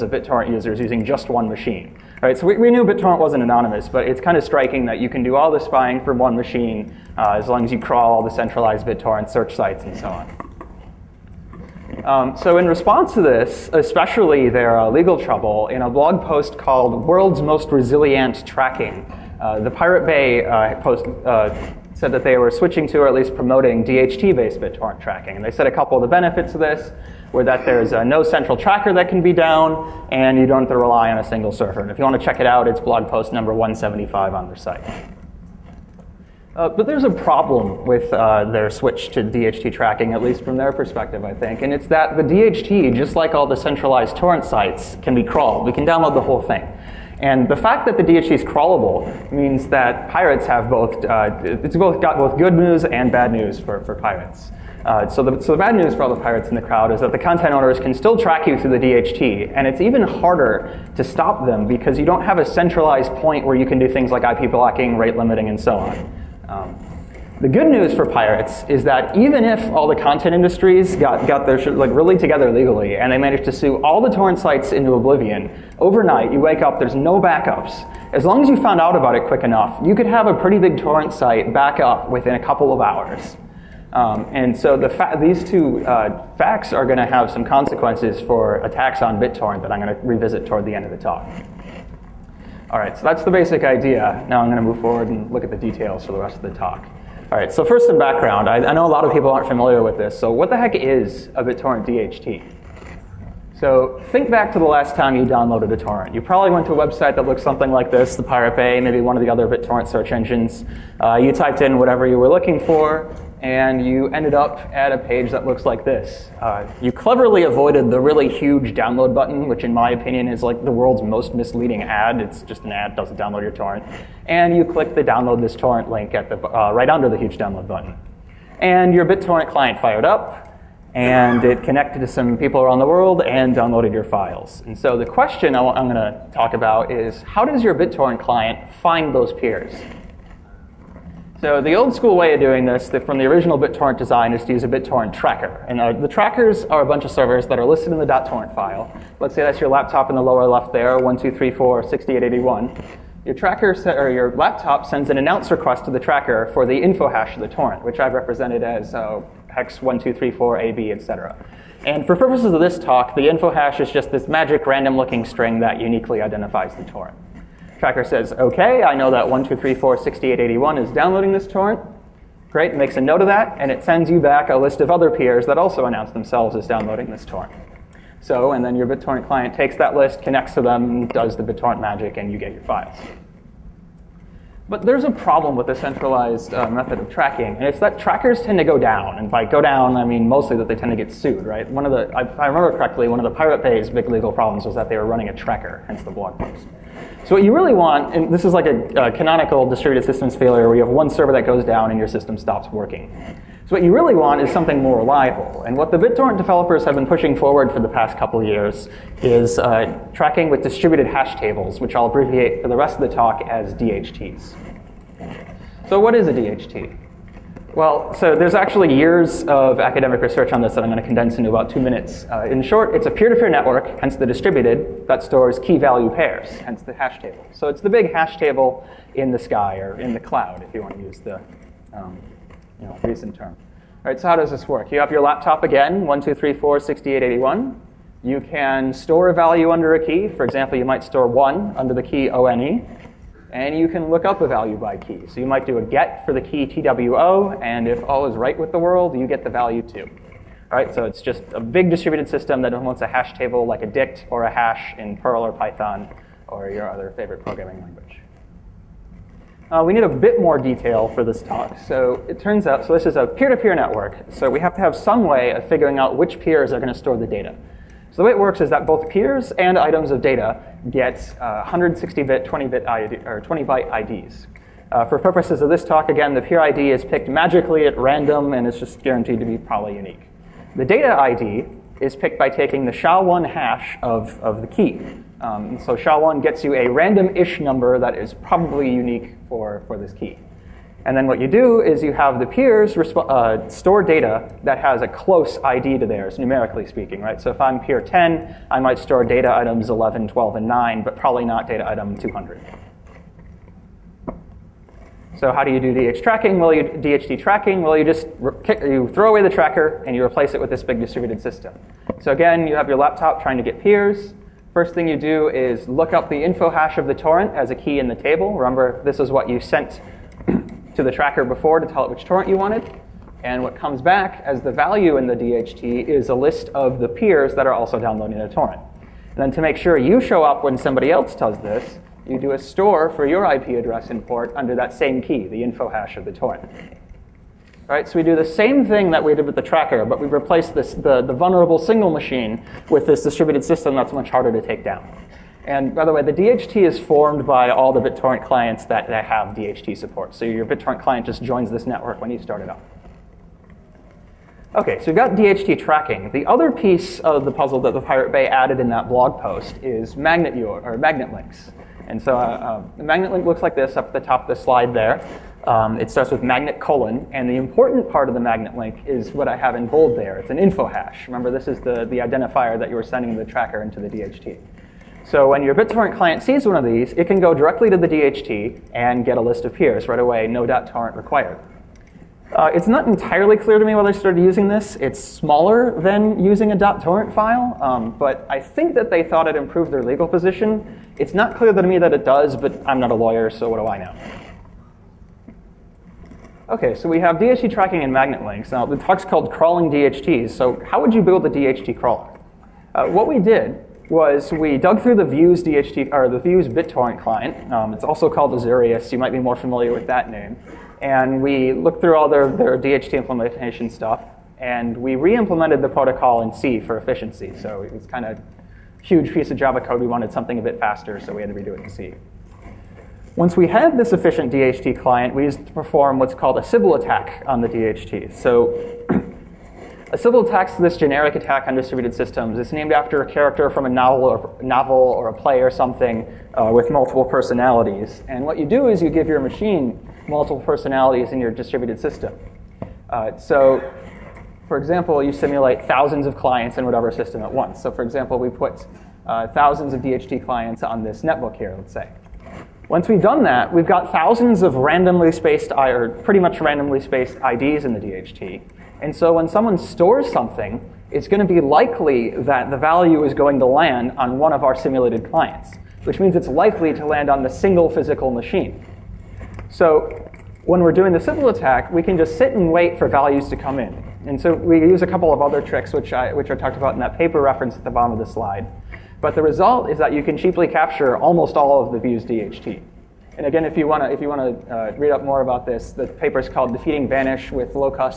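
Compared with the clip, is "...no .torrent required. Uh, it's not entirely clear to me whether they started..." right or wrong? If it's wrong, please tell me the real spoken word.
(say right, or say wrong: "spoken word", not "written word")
right.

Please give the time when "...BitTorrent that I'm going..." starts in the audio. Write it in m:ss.
1:29.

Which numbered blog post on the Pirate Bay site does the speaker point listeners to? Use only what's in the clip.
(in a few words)
175.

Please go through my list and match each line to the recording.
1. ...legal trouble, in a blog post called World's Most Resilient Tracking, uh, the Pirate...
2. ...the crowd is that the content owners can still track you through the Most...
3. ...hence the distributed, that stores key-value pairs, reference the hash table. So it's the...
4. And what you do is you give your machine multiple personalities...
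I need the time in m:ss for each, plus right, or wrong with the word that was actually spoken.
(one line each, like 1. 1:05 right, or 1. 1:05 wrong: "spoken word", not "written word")
1. 0:14 right
2. 0:56 wrong: "DHT", not "Most"
3. 3:44 wrong: "hence", not "reference"
4. 7:18 right.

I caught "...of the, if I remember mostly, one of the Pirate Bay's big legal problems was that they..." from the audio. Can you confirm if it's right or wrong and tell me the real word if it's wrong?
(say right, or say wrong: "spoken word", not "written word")
wrong: "correctly", not "mostly".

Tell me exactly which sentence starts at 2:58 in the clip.
So, and then your BitTorrent client takes that list, connects to them, does the BitTorrent magic, and you get your files.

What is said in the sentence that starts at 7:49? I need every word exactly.
So when we're doing the Sybil attack, we can just sit and wait for values to come in.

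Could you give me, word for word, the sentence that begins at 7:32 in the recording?
Once we've done that, we've got thousands of randomly spaced, or pretty much randomly spaced IDs in the DHT.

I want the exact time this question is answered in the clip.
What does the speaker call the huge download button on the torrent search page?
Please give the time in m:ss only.
2:00.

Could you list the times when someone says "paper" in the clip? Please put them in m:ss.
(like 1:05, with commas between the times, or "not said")
7:57, 8:06.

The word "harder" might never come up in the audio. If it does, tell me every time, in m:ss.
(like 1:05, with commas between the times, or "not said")
1:00, 5:44.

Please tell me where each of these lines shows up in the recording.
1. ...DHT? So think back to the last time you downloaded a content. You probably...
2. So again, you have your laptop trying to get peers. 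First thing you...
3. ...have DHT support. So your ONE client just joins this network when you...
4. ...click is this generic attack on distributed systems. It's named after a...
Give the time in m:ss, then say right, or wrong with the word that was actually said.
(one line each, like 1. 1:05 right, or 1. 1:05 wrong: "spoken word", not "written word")
1. 1:41 wrong: "torrent", not "content"
2. 5:12 right
3. 5:49 wrong: "BitTorrent", not "ONE"
4. 7:10 wrong: "attack", not "click".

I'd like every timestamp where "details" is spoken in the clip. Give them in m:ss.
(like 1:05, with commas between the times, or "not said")
1:35, 4:20.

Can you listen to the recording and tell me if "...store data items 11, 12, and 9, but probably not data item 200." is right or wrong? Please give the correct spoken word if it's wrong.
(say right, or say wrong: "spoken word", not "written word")
right.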